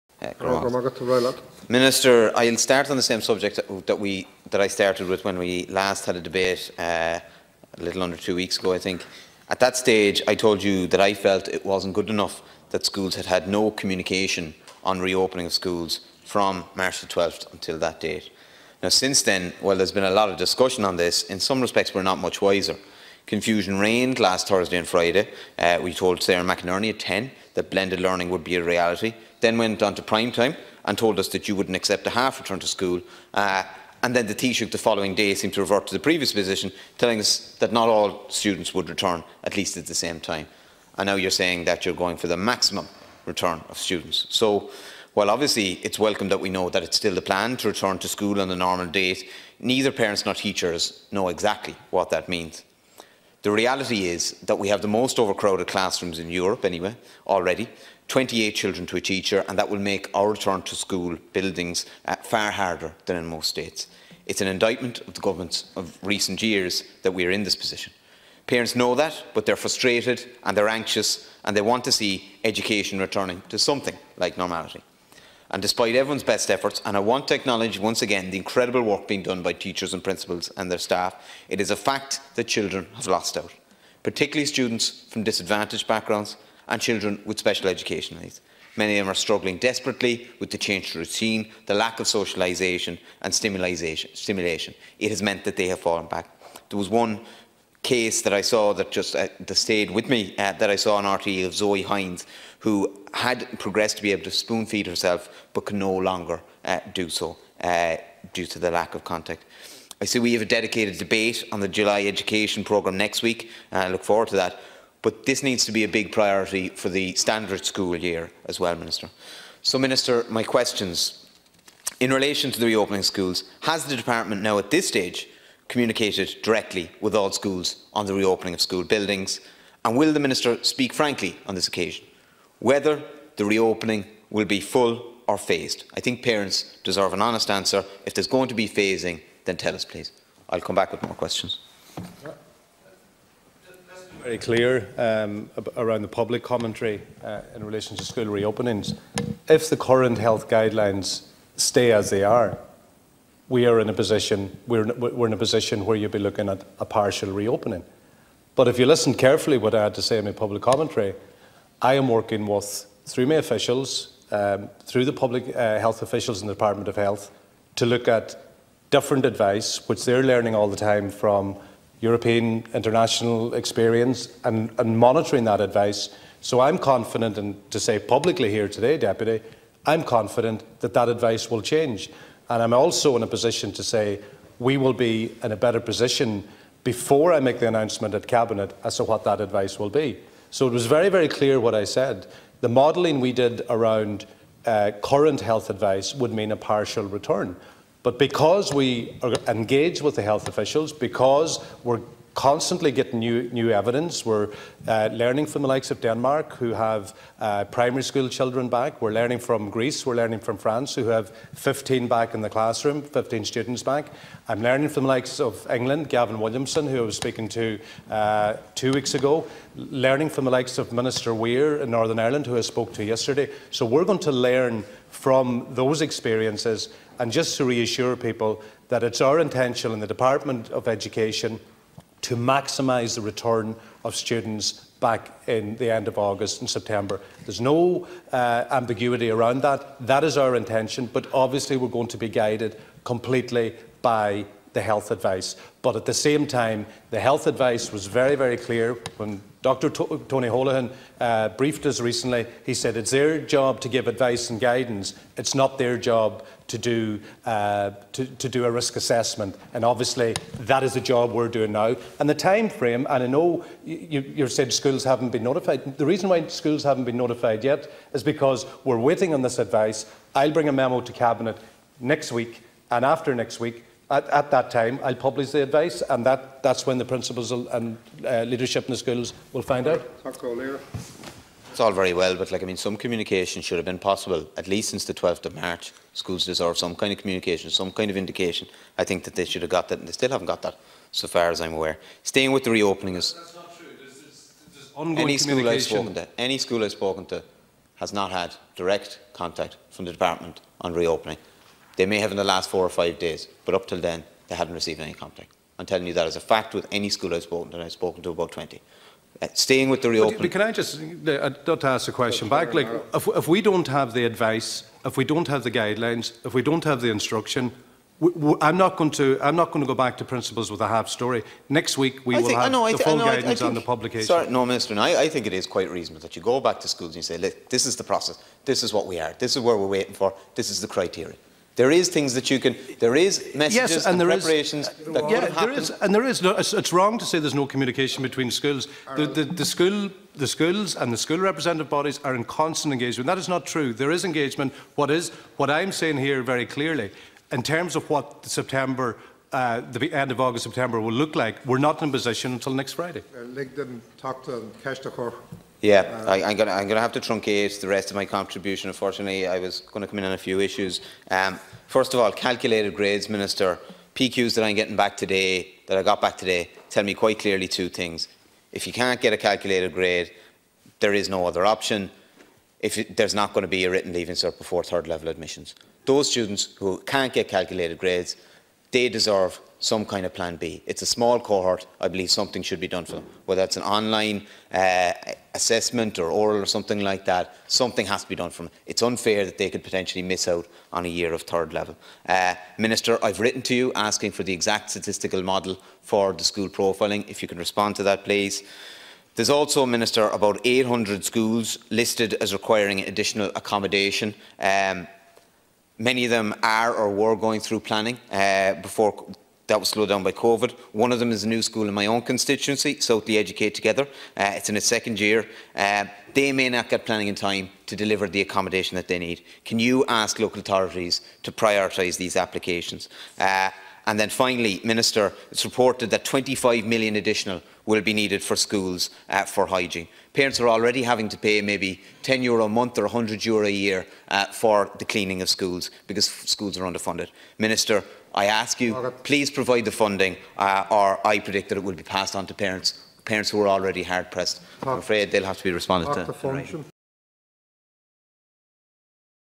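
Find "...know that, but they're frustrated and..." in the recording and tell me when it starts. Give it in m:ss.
1:08.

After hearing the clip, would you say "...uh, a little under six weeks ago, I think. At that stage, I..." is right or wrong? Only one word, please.
wrong.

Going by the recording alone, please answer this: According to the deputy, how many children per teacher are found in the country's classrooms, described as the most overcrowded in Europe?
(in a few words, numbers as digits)
28.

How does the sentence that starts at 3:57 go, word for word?
There's no uh, ambiguity around that.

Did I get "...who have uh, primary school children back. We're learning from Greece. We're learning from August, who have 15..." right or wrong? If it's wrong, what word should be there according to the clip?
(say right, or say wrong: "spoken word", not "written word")
wrong: "France", not "August".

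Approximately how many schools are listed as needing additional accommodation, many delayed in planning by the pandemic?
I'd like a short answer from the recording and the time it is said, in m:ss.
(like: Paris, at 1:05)
800, at 6:40.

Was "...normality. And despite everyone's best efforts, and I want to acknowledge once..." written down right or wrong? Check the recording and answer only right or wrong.
right.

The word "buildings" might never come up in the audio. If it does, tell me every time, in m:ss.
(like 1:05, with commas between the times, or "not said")
1:01, 2:08.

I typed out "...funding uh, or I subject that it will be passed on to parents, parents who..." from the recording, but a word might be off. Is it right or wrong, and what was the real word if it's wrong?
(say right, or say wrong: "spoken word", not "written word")
wrong: "predict", not "subject".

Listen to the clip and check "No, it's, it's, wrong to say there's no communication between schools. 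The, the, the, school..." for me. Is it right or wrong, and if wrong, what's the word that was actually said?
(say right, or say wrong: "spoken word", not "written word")
right.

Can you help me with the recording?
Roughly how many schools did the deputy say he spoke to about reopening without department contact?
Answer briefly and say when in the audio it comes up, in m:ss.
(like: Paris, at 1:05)
20, at 5:08.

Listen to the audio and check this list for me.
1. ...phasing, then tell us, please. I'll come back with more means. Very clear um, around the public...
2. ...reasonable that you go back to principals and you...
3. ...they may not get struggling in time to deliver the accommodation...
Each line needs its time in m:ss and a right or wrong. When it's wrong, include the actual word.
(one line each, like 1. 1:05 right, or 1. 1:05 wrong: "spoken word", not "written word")
1. 2:18 wrong: "questions", not "means"
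2. 5:25 wrong: "schools", not "principals"
3. 6:56 wrong: "planning", not "struggling".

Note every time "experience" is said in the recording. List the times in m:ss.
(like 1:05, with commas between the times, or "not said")
2:53, 3:46.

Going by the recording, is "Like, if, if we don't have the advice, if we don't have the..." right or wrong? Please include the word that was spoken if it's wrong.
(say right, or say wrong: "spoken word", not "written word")
right.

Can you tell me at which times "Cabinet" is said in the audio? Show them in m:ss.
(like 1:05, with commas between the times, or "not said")
3:08, 4:31.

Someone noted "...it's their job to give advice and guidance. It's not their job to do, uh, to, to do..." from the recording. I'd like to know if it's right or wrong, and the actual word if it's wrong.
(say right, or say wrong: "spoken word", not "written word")
right.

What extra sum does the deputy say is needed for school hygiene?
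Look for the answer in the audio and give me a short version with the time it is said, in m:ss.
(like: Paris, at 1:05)
25 million, at 7:06.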